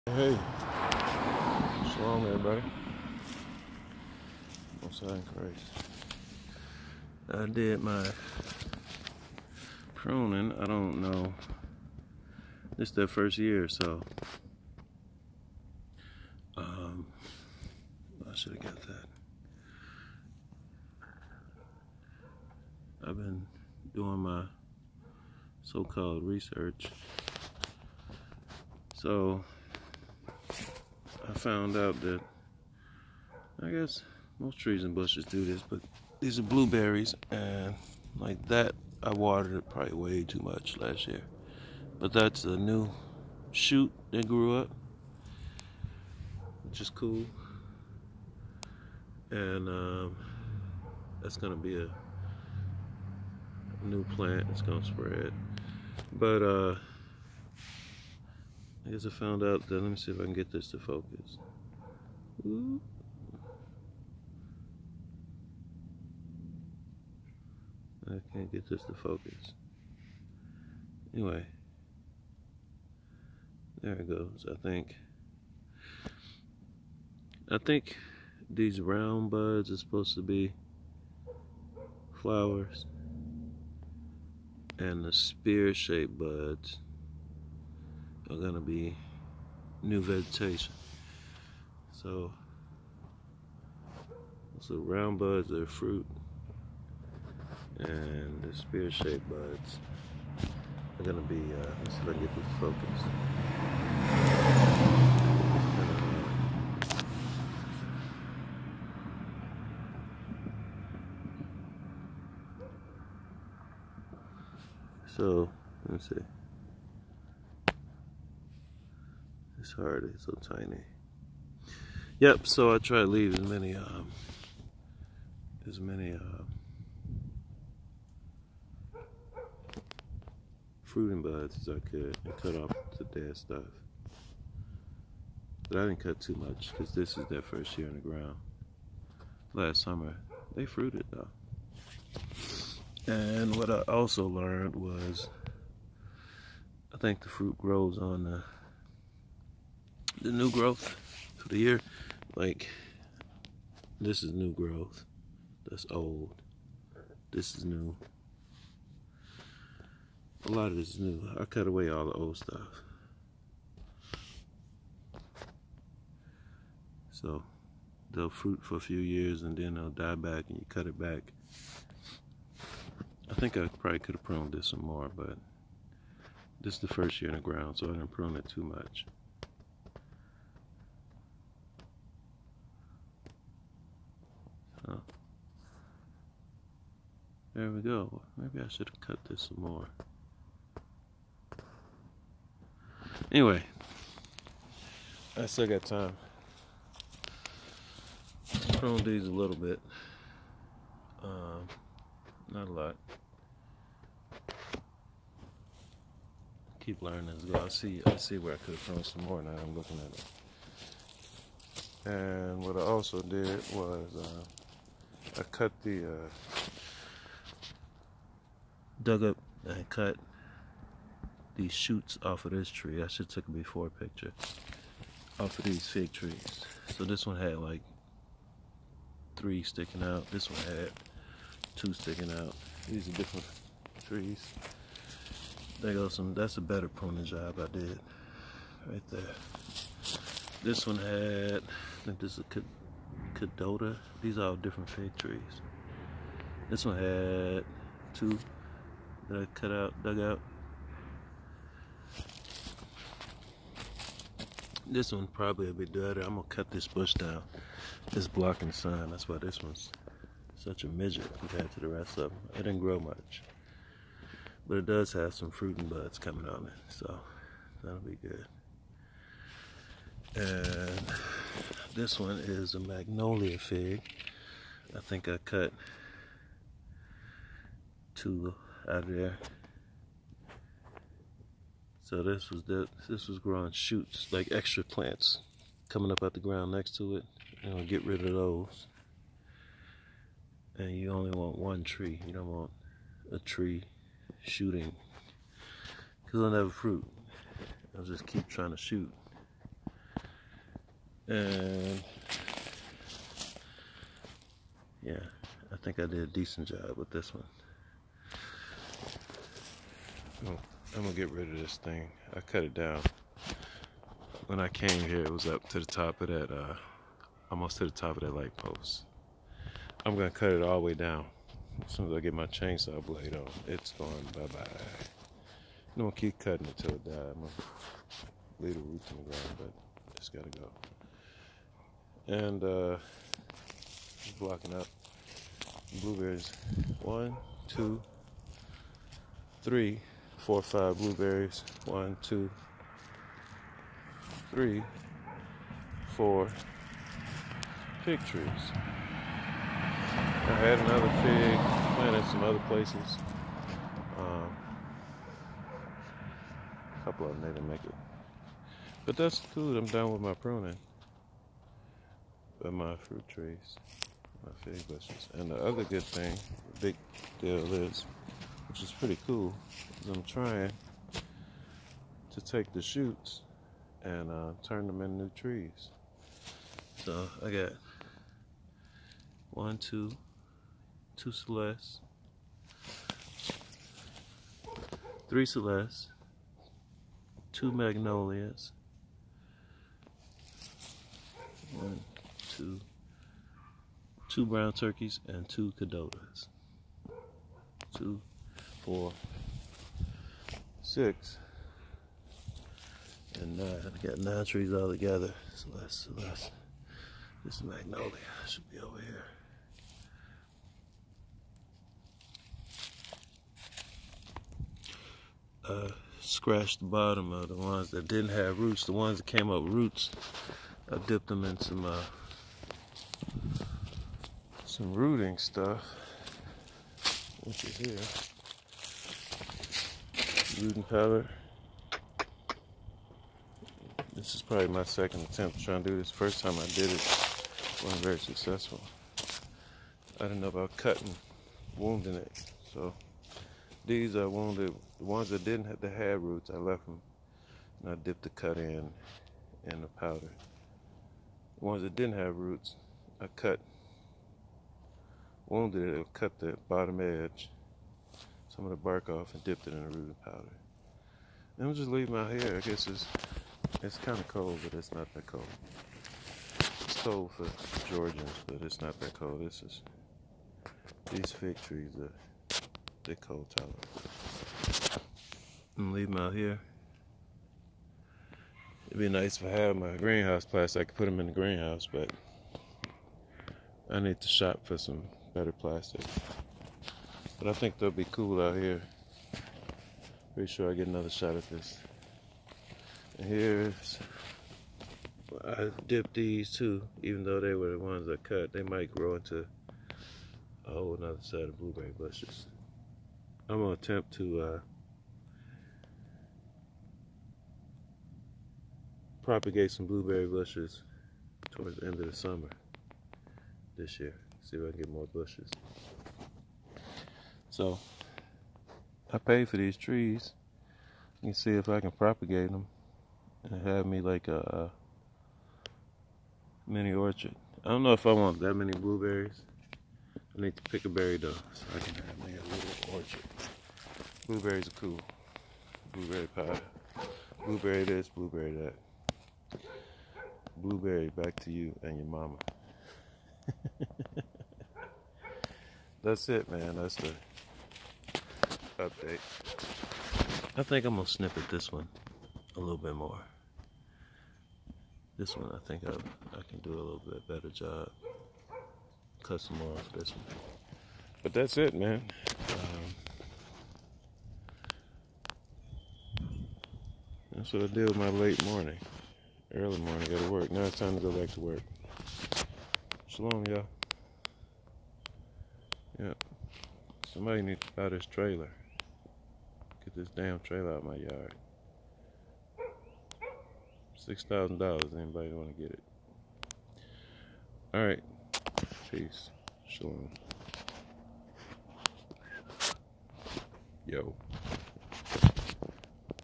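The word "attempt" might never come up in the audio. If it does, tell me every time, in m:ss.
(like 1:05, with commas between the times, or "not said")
7:15, 8:23.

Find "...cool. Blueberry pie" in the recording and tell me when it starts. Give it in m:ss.
8:54.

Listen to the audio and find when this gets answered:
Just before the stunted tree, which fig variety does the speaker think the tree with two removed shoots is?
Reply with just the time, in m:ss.
4:03.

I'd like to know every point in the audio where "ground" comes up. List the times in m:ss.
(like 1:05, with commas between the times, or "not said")
2:18, 2:57, 4:46, 5:29.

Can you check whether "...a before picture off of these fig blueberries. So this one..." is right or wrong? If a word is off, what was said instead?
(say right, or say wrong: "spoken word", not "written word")
wrong: "trees", not "blueberries".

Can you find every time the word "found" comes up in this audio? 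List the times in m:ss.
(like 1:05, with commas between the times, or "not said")
0:31, 0:59.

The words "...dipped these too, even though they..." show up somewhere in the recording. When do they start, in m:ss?
8:15.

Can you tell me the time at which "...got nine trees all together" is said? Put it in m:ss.
6:44.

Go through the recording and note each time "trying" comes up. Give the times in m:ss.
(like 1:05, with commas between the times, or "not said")
4:58, 6:10, 7:15.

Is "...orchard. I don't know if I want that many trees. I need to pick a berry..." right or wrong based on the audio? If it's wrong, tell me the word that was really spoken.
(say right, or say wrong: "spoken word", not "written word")
wrong: "blueberries", not "trees".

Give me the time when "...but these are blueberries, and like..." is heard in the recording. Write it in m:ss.
0:35.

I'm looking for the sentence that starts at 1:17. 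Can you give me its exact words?
I think these round buds are supposed to be flowers and the spear-shaped buds are going to be new vegetation.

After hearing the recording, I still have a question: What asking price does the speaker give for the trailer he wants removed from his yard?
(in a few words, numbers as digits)
$6,000.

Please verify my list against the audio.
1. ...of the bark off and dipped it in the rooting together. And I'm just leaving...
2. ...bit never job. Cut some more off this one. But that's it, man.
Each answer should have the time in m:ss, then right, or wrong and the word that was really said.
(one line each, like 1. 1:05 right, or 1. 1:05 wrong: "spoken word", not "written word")
1. 7:38 wrong: "powder", not "together"
2. 9:17 wrong: "better", not "never".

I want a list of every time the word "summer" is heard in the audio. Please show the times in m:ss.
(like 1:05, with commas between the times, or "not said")
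2:19, 8:32.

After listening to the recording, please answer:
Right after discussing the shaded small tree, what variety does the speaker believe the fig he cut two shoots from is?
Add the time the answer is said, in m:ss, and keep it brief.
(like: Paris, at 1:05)
Magnolia fig, at 4:32.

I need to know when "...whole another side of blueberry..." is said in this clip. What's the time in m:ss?
8:20.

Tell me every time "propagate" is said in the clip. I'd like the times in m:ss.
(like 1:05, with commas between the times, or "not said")
8:29, 8:41.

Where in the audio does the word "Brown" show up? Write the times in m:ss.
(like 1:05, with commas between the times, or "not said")
6:34.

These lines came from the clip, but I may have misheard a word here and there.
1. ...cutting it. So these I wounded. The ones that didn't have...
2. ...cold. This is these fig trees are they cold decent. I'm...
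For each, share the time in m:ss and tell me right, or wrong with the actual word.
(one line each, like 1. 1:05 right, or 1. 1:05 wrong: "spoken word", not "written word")
1. 7:21 wrong: "wounding", not "cutting"
2. 7:49 wrong: "tolerant", not "decent".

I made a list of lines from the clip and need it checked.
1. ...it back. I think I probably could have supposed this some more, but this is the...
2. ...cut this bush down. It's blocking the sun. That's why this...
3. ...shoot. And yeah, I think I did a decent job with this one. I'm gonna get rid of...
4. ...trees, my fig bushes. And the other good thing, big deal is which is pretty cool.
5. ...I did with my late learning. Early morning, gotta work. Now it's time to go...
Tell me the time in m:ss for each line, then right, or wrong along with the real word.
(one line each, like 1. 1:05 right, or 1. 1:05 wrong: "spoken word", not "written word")
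1. 2:50 wrong: "pruned", not "supposed"
2. 4:16 right
3. 4:58 right
4. 6:03 right
5. 9:27 wrong: "morning", not "learning".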